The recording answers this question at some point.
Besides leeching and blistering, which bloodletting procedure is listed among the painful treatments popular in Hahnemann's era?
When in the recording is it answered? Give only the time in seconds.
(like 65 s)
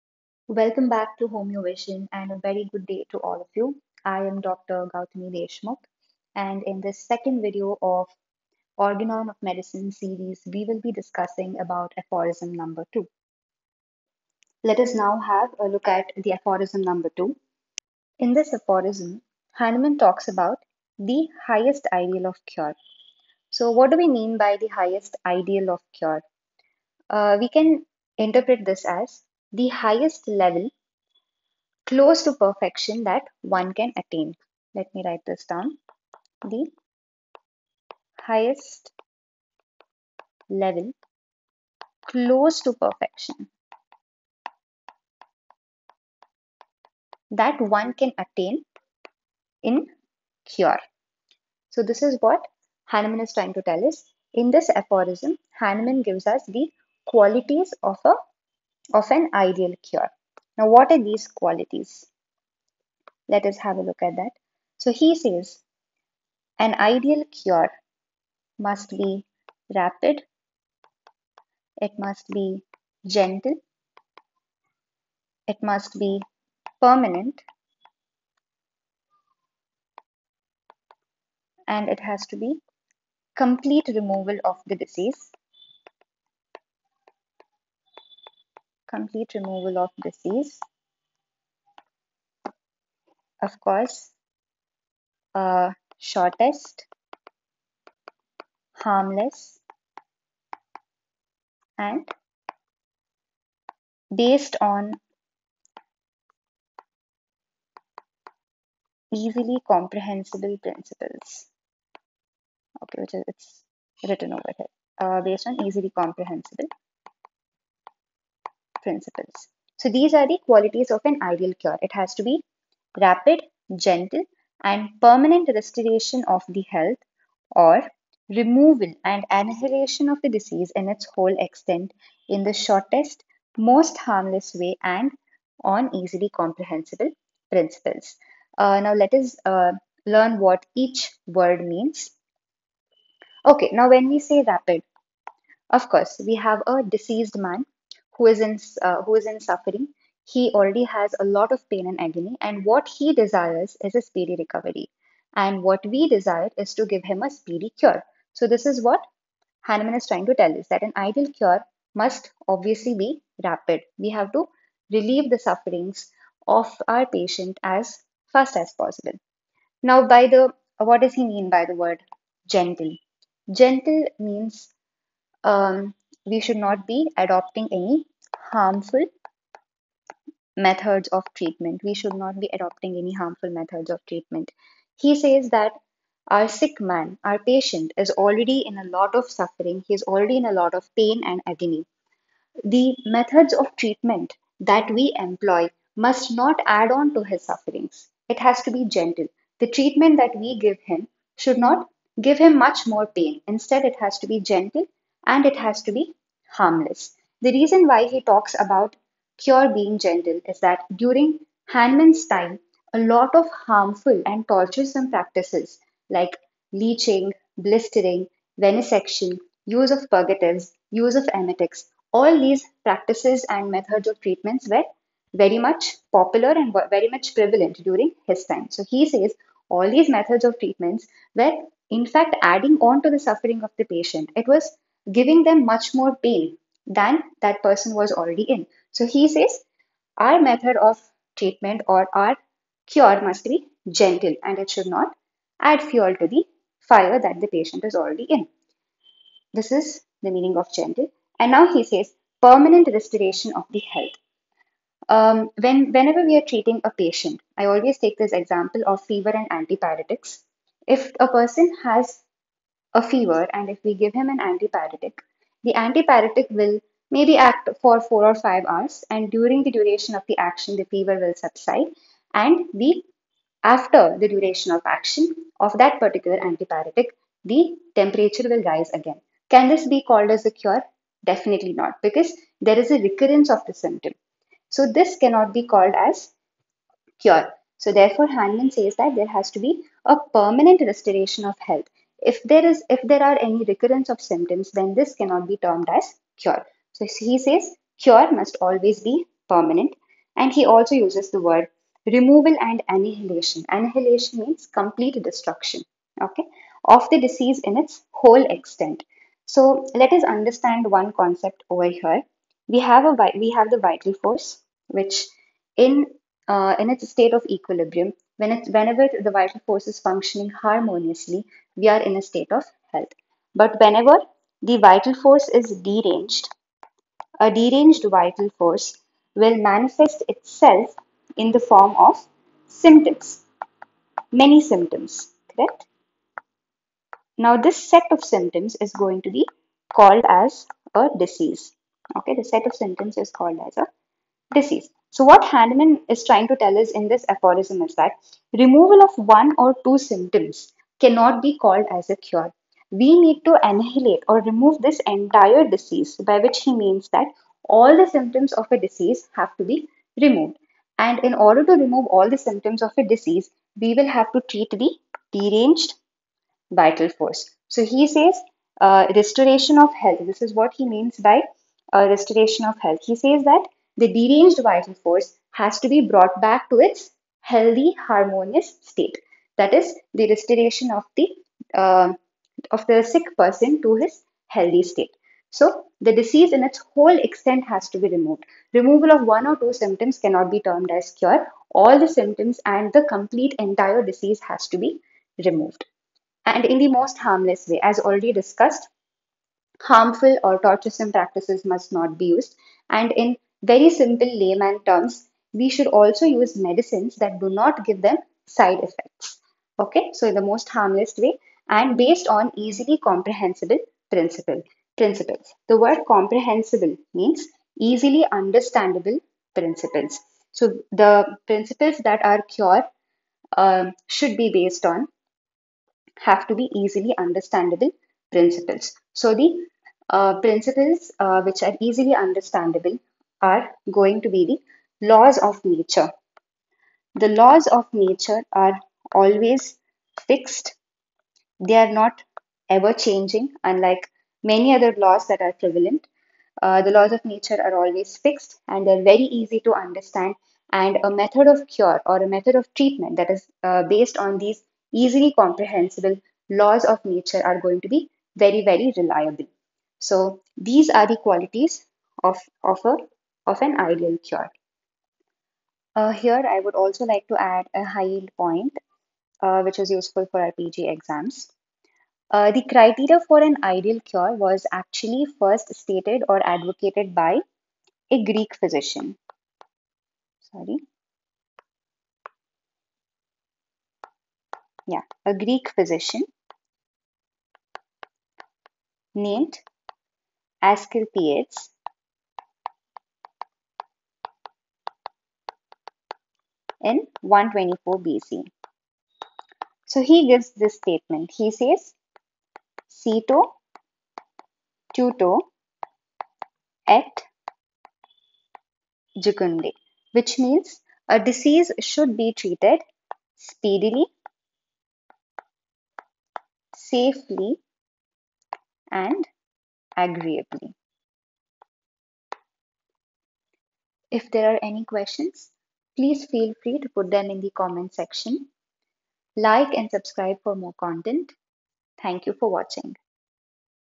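218 s.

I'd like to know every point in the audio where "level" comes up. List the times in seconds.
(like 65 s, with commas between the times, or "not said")
30 s, 40 s.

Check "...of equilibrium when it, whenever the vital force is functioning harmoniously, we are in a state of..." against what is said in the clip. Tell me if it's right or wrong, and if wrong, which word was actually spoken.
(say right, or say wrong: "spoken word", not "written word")
right.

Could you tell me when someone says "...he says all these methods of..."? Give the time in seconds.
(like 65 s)
228 s.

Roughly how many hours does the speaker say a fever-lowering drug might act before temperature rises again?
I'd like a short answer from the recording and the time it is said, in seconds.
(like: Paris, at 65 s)
4 or 5 hours, at 268 s.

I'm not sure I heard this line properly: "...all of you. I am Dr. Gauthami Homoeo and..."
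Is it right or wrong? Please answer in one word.
wrong.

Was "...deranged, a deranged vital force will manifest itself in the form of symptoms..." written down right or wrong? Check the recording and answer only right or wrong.
right.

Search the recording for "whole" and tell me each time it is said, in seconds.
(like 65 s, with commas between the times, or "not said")
131 s, 308 s, 386 s.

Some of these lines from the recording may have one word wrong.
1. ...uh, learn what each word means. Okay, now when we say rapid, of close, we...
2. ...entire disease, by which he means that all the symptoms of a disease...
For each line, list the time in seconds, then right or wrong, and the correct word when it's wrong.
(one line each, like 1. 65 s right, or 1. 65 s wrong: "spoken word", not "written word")
1. 139 s wrong: "course", not "close"
2. 355 s right.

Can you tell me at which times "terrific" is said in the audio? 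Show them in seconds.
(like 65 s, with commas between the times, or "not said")
not said.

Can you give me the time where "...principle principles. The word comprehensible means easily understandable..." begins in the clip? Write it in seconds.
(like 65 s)
414 s.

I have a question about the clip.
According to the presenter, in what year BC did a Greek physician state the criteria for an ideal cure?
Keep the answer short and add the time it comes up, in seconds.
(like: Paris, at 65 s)
124 BC, at 497 s.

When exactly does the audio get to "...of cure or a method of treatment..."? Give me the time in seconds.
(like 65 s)
451 s.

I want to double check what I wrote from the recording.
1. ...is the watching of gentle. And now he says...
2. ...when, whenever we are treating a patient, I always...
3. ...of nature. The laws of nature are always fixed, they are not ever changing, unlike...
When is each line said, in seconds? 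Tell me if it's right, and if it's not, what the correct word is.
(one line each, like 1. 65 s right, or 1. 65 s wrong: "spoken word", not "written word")
1. 249 s wrong: "meaning", not "watching"
2. 255 s right
3. 435 s right.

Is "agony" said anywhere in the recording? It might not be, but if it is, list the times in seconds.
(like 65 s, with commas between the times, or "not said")
152 s, 191 s.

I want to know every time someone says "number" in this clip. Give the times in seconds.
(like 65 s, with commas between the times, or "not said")
12 s, 16 s.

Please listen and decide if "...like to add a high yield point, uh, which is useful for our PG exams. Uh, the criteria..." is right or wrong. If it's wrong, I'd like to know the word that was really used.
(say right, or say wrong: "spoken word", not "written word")
right.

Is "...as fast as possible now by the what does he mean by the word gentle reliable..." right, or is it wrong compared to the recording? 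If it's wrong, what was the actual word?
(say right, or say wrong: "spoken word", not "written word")
wrong: "gentle", not "reliable".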